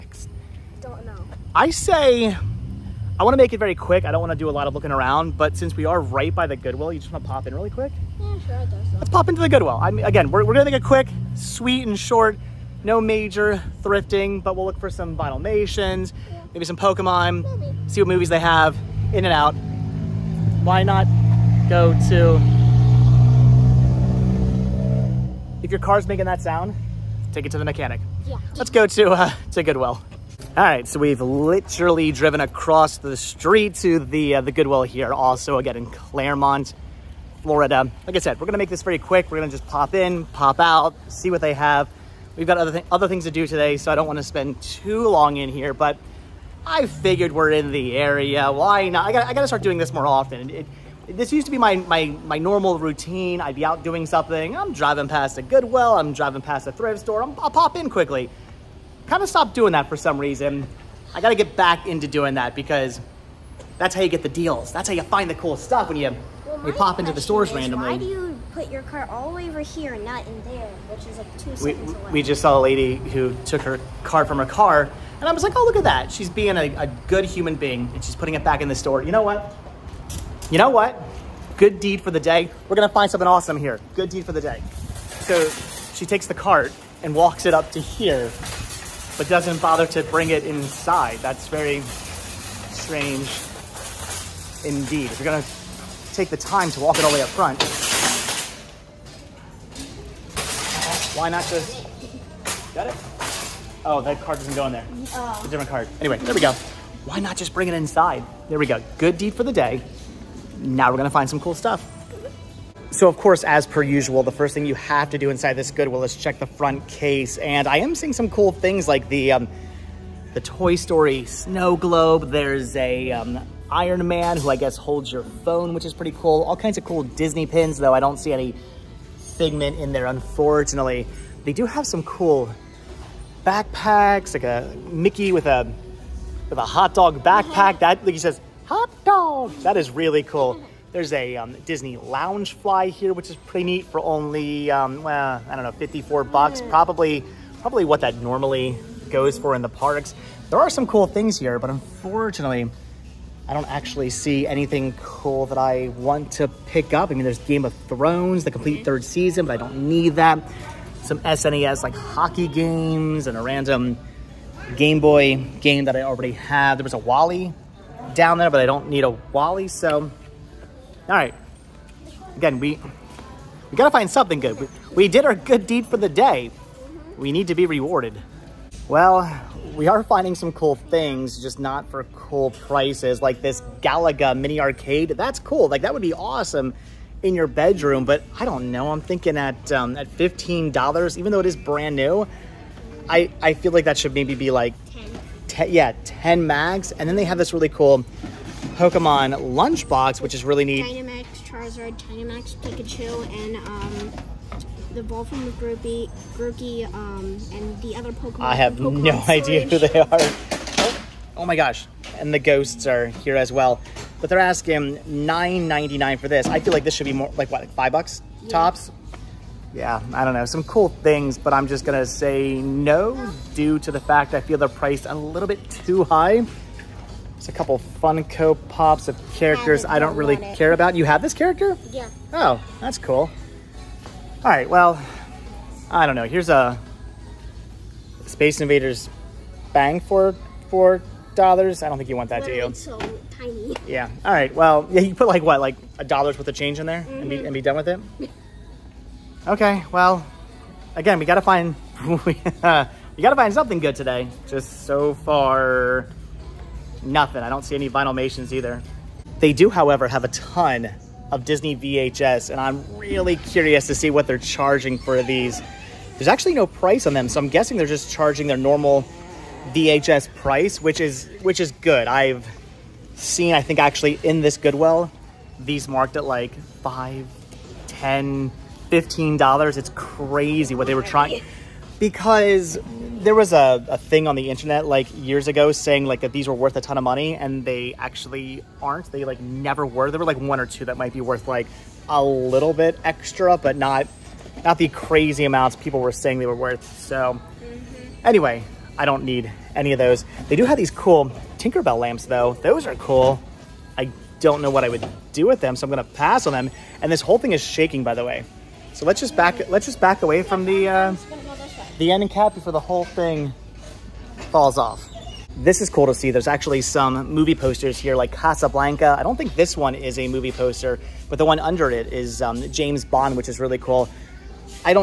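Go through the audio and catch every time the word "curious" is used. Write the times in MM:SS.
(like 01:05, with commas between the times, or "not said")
04:23.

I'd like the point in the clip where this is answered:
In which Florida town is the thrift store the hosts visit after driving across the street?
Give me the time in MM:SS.
00:35.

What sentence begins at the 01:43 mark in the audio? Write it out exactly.
Oh, that card doesn't go in there.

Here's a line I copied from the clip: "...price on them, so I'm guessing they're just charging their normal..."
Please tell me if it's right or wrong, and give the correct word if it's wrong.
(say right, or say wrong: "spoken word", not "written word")
right.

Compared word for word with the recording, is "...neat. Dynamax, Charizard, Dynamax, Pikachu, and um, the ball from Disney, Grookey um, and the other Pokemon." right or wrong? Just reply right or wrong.
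wrong.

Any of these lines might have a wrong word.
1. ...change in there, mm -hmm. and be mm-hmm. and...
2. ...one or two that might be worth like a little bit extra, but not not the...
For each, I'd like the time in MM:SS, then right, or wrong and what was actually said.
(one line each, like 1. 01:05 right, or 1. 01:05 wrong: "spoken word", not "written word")
1. 04:06 right
2. 04:50 right.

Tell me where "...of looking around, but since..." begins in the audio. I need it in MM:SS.
00:04.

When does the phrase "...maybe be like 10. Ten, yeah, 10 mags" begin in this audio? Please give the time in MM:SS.
03:14.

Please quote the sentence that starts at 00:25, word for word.
If your car's making that sound, take it to the mechanic.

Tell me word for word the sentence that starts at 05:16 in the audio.
There's actually some movie posters here like Casablanca.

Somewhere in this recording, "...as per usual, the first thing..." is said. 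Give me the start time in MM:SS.
01:53.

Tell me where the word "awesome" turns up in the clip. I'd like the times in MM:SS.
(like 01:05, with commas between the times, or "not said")
01:23, 03:06.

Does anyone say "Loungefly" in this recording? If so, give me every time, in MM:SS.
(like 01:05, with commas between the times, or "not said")
02:21.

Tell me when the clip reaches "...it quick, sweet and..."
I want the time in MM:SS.
00:10.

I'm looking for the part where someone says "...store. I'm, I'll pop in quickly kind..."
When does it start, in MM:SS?
00:57.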